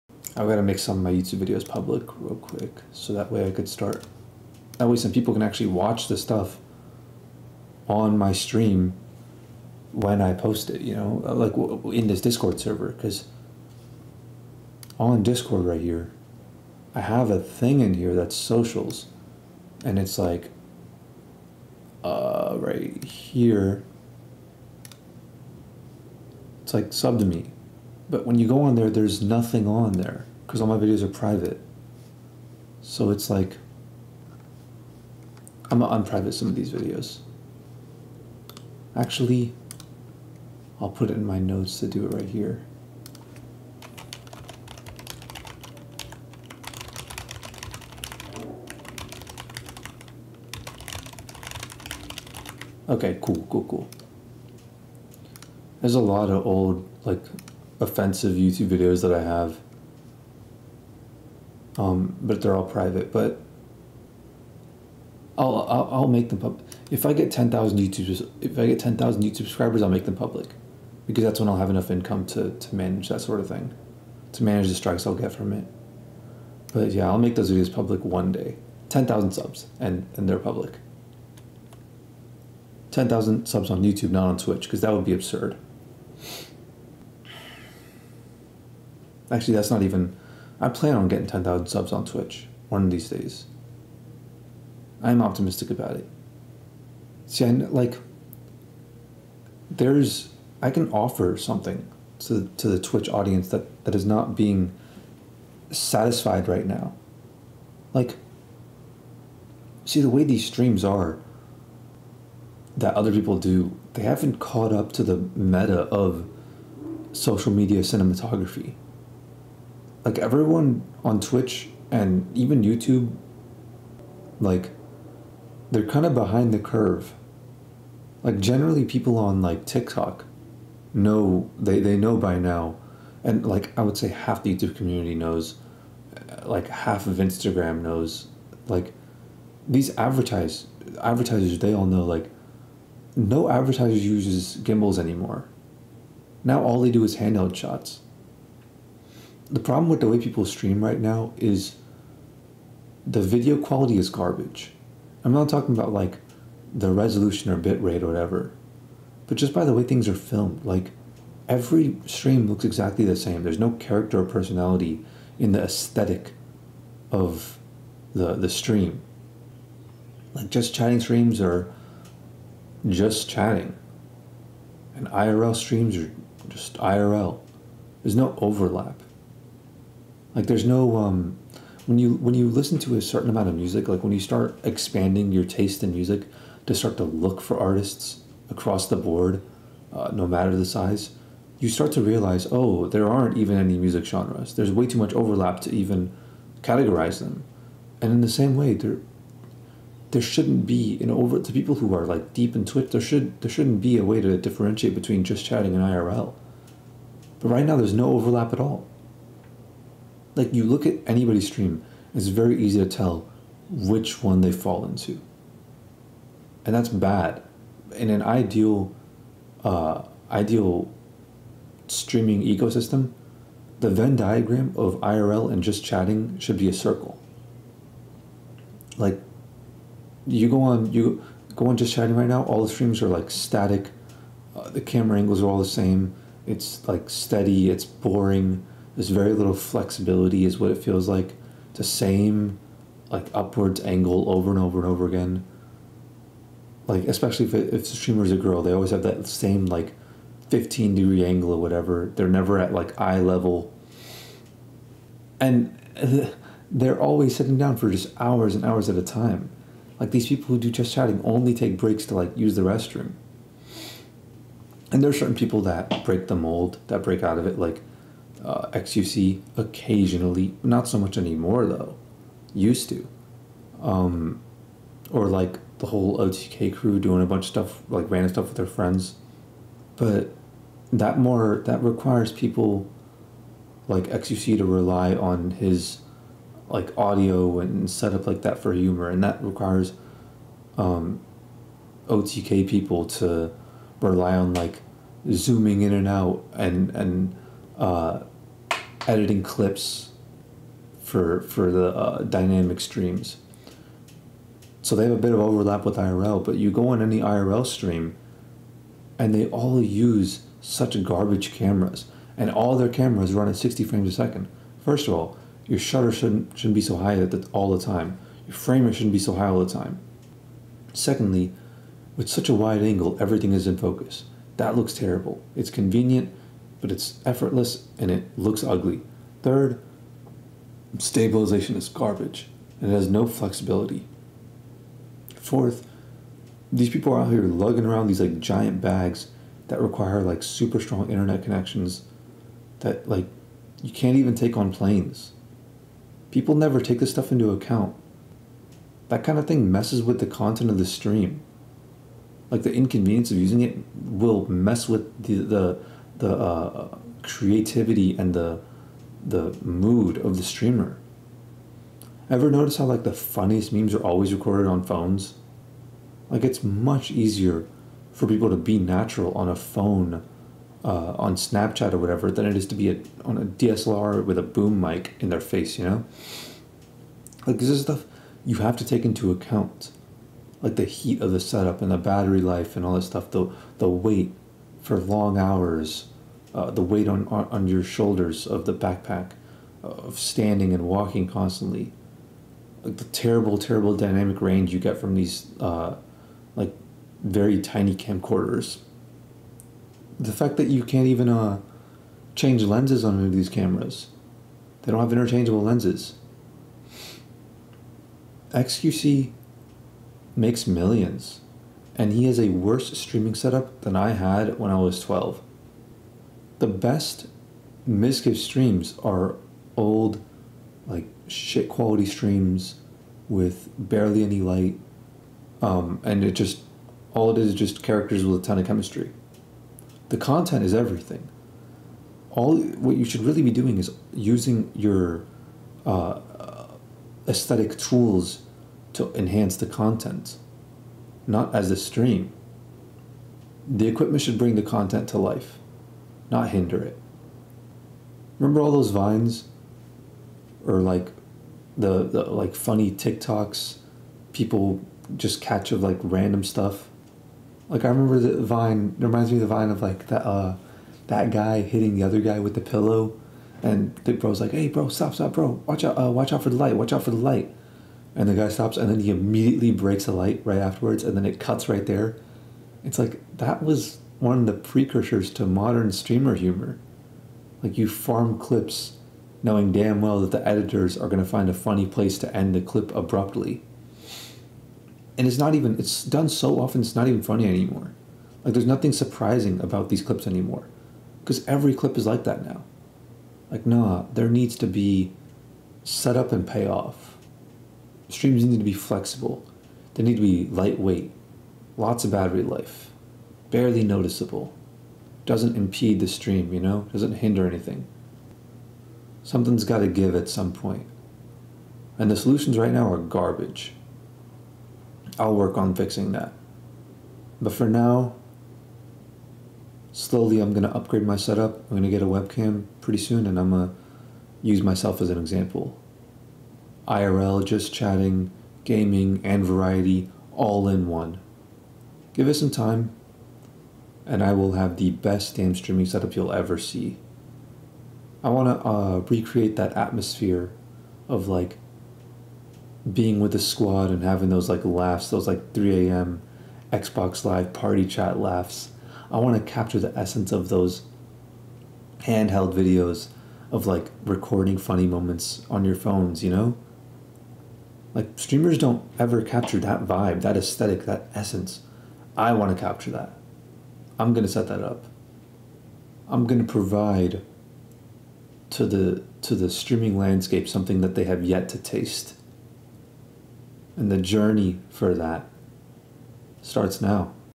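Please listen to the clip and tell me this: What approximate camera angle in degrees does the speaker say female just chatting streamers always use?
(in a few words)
15 degrees.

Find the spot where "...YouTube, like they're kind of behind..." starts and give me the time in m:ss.
2:02.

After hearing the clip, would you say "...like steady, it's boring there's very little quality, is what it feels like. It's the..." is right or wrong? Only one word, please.
wrong.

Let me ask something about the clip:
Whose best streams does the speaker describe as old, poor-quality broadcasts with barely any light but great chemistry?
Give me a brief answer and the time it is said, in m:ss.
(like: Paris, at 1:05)
Mizkif, at 6:57.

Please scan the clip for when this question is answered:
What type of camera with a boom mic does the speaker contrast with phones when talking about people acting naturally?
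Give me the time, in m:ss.
6:13.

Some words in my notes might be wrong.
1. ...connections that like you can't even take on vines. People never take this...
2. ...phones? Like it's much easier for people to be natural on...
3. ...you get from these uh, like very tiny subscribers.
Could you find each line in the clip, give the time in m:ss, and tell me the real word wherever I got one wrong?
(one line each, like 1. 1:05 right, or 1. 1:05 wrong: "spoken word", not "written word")
1. 5:41 wrong: "planes", not "vines"
2. 6:04 right
3. 6:34 wrong: "camcorders", not "subscribers".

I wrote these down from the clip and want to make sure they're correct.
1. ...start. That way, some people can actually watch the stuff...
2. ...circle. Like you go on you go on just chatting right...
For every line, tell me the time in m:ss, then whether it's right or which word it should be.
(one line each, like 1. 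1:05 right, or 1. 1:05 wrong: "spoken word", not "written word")
1. 0:03 right
2. 3:46 right.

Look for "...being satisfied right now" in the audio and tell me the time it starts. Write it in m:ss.
1:44.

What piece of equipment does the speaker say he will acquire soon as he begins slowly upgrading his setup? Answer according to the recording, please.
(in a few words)
a webcam.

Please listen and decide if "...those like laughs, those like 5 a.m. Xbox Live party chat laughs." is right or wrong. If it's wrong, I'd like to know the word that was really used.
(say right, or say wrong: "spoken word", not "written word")
wrong: "3", not "5".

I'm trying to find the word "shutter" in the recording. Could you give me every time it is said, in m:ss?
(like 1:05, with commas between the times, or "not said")
5:15.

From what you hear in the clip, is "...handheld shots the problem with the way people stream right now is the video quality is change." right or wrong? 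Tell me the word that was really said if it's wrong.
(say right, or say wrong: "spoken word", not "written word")
wrong: "garbage", not "change".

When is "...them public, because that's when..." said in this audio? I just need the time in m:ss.
1:10.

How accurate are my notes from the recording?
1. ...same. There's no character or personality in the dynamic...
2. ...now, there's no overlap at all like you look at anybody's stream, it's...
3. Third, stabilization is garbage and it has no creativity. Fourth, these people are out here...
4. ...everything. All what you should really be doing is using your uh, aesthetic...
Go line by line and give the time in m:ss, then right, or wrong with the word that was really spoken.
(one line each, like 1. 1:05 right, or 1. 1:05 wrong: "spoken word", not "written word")
1. 2:43 wrong: "aesthetic", not "dynamic"
2. 3:27 right
3. 5:29 wrong: "flexibility", not "creativity"
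4. 7:10 right.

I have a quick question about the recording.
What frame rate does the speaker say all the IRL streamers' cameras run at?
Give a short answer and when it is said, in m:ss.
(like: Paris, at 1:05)
60 frames per second, at 5:13.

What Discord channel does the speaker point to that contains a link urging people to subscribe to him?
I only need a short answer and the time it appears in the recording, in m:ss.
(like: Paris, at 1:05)
socials, at 0:18.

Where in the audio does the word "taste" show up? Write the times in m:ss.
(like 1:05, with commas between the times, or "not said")
3:05, 9:31.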